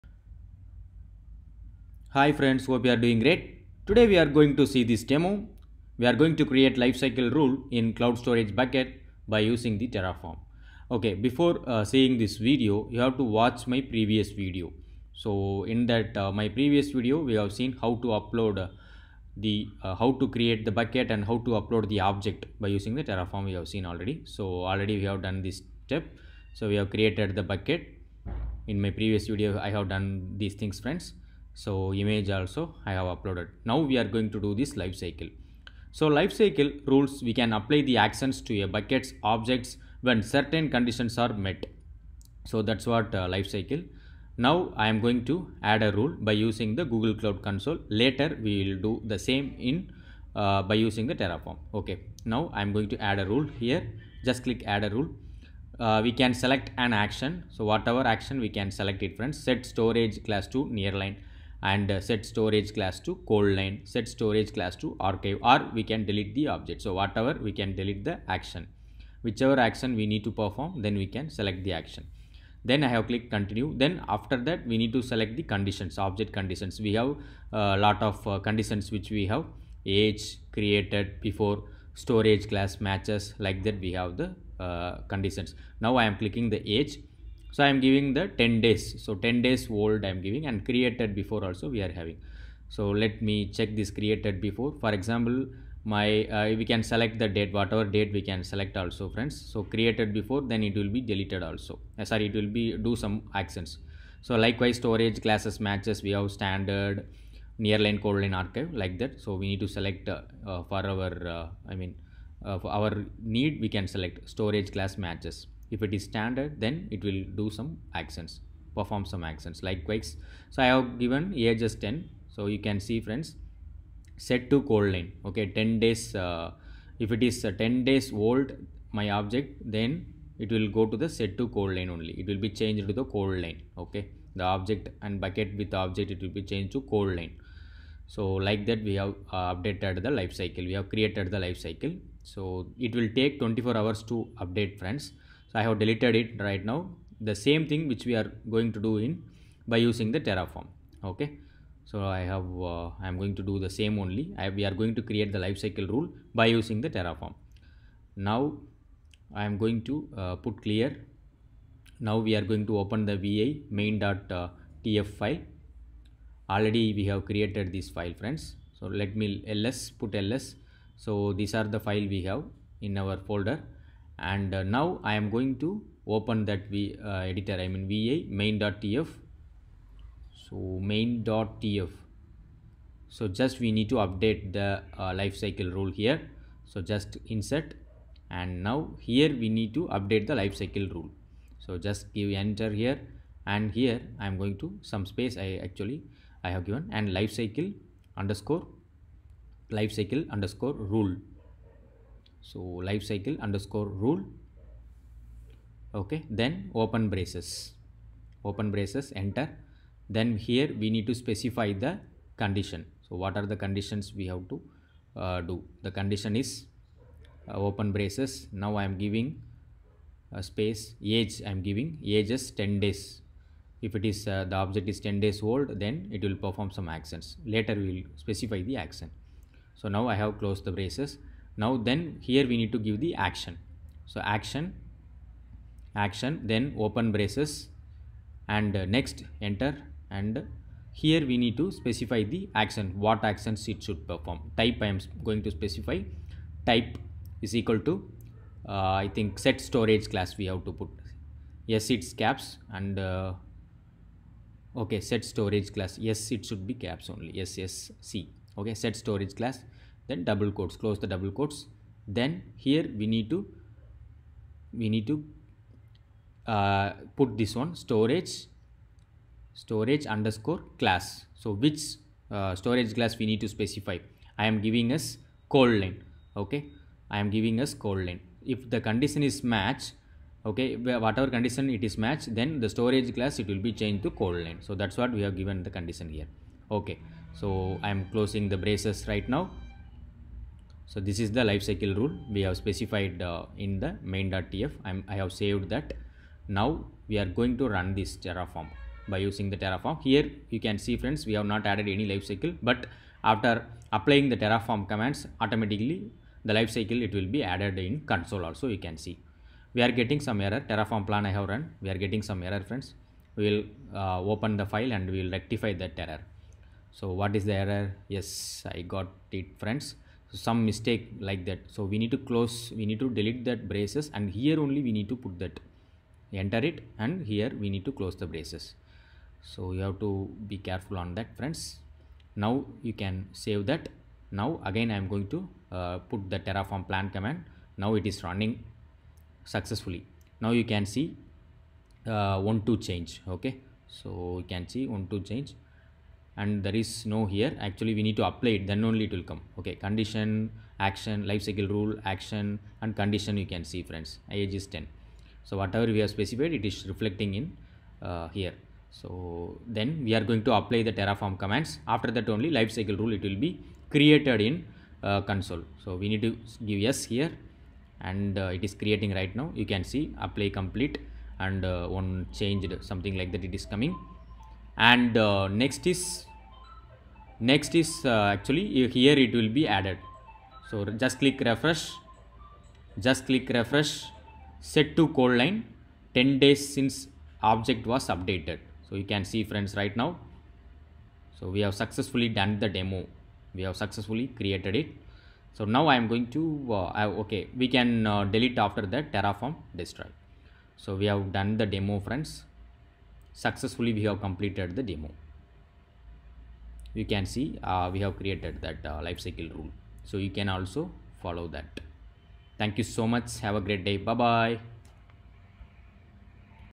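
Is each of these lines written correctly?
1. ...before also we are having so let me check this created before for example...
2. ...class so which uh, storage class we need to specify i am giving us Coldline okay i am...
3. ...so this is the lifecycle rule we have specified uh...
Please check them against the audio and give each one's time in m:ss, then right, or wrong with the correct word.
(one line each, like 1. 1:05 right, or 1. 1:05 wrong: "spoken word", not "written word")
1. 1:31 right
2. 4:30 right
3. 4:50 right.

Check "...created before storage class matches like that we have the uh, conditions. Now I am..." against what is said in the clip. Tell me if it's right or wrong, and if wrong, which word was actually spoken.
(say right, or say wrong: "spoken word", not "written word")
right.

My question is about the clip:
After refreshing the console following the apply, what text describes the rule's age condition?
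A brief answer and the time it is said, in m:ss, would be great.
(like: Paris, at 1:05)
10 days since object was updated, at 6:26.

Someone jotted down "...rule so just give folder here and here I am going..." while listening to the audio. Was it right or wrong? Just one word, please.
wrong.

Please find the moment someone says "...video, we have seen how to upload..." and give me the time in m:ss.
0:16.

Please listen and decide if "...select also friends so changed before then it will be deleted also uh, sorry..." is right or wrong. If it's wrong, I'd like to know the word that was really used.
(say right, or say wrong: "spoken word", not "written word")
wrong: "created", not "changed".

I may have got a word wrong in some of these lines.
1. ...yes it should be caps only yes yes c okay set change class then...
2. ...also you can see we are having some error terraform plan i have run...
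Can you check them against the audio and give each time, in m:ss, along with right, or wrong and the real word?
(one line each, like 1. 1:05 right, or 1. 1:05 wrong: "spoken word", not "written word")
1. 4:16 wrong: "storage", not "change"
2. 5:08 wrong: "getting", not "having".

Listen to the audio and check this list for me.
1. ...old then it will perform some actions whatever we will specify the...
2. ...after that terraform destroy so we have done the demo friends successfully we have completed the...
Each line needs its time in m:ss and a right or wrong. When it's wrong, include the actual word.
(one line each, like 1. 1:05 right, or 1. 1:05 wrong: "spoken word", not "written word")
1. 3:45 wrong: "later", not "whatever"
2. 6:38 right.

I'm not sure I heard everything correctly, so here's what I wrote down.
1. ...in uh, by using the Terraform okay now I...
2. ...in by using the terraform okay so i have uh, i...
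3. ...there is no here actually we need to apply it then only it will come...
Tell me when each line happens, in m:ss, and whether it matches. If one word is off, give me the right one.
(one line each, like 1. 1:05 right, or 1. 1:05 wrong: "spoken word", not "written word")
1. 0:49 right
2. 2:29 right
3. 5:46 right.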